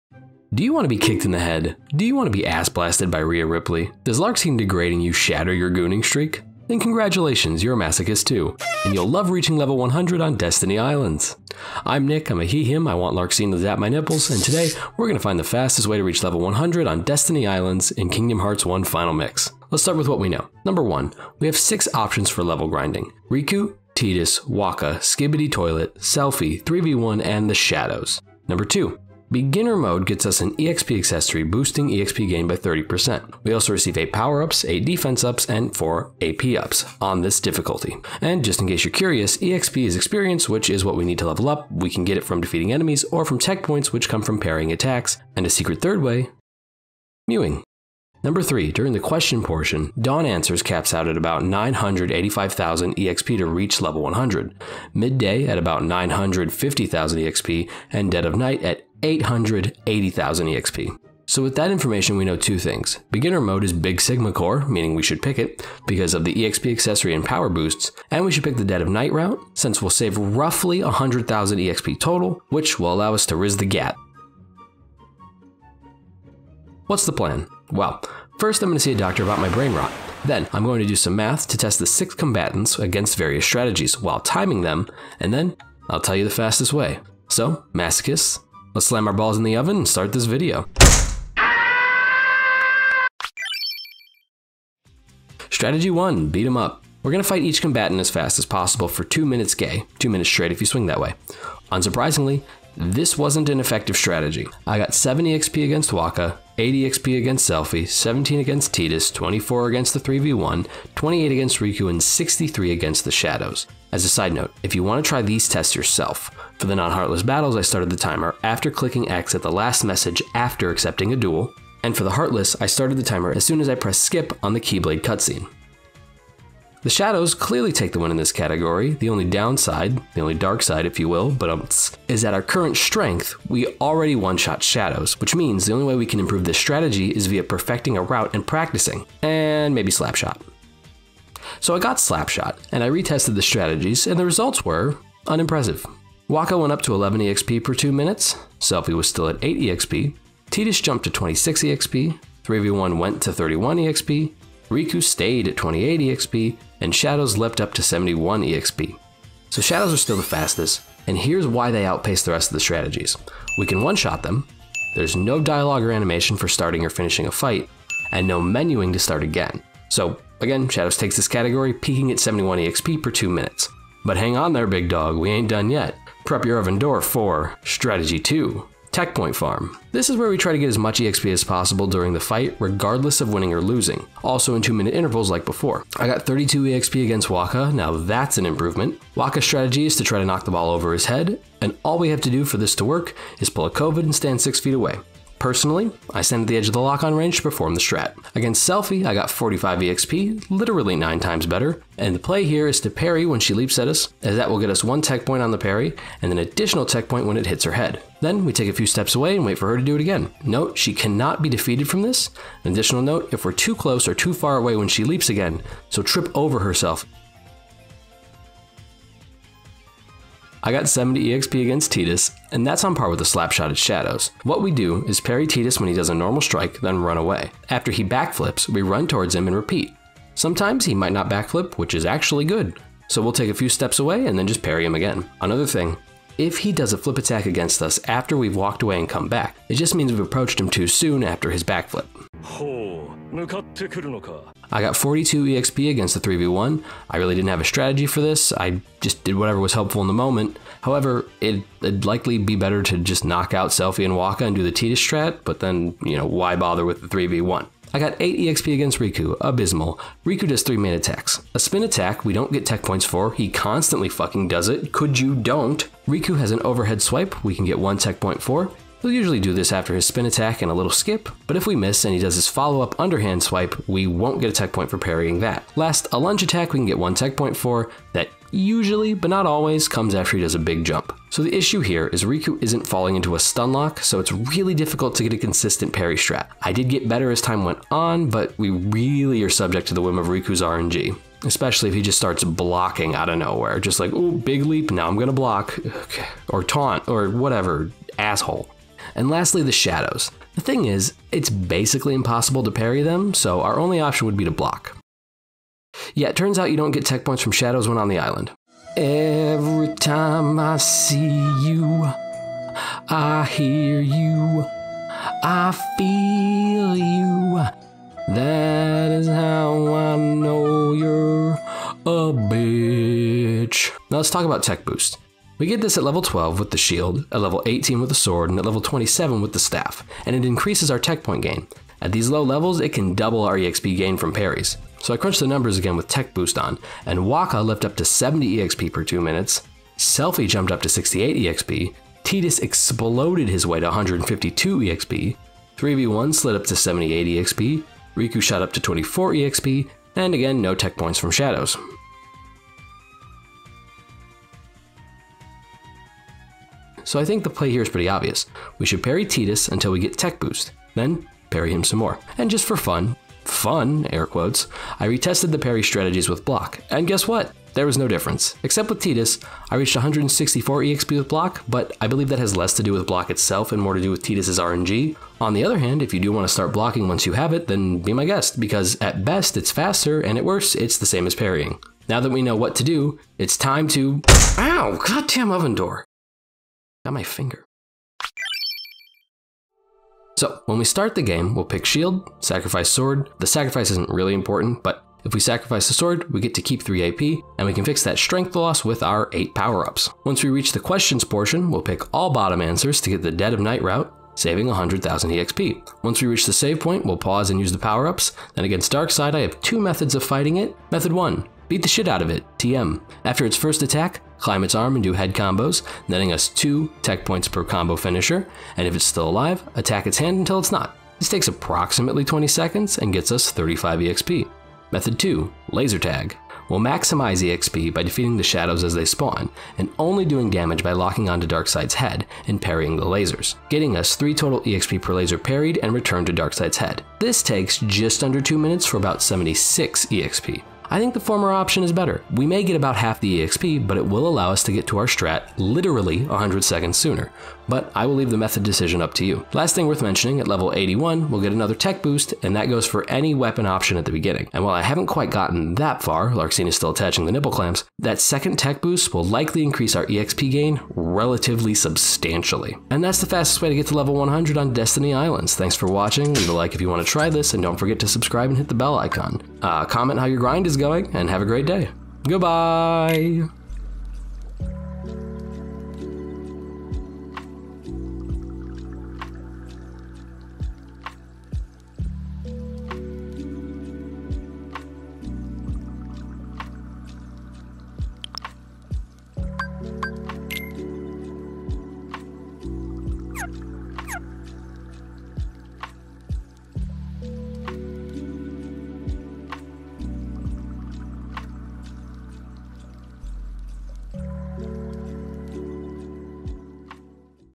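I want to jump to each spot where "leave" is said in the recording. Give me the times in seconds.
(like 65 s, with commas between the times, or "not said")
448 s, 466 s.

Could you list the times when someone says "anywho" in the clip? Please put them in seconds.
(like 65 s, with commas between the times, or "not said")
not said.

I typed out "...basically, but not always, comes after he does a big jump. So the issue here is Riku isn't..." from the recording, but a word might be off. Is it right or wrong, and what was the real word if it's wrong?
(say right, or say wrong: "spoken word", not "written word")
wrong: "usually", not "basically".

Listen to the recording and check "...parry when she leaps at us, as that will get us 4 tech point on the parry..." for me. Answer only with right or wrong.
wrong.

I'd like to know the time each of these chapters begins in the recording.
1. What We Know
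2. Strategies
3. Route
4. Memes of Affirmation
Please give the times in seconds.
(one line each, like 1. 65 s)
1. 18 s
2. 93 s
3. 388 s
4. 474 s.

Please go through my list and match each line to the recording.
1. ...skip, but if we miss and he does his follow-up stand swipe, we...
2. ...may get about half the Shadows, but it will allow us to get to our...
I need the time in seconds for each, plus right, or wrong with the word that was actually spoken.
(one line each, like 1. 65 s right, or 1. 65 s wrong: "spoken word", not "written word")
1. 270 s wrong: "underhand", not "stand"
2. 442 s wrong: "EXP", not "Shadows".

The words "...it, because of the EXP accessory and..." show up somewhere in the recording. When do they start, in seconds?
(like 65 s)
65 s.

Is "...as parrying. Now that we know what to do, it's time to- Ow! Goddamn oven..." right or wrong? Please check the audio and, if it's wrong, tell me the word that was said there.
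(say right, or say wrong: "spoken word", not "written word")
right.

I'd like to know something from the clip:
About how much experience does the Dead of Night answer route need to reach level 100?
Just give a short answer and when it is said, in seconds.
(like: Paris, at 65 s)
880,000, at 59 s.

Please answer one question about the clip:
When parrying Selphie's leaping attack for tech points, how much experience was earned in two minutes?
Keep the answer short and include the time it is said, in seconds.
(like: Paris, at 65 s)
45, at 199 s.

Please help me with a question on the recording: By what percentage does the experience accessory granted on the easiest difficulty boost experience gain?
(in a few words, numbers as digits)
30%.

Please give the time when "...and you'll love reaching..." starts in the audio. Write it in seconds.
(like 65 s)
8 s.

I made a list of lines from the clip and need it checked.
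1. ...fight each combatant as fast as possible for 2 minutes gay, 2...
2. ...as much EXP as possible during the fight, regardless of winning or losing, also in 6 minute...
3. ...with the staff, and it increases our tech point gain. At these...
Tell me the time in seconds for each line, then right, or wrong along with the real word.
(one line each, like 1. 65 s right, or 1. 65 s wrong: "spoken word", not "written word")
1. 97 s right
2. 180 s wrong: "2", not "6"
3. 329 s right.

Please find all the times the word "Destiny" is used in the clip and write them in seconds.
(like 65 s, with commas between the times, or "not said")
10 s, 17 s, 464 s.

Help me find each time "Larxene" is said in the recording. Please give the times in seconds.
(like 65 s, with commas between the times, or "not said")
13 s, 456 s.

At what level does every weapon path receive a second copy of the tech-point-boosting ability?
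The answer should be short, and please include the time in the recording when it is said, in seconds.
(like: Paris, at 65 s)
81, at 450 s.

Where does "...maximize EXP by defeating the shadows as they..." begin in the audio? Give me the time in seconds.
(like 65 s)
426 s.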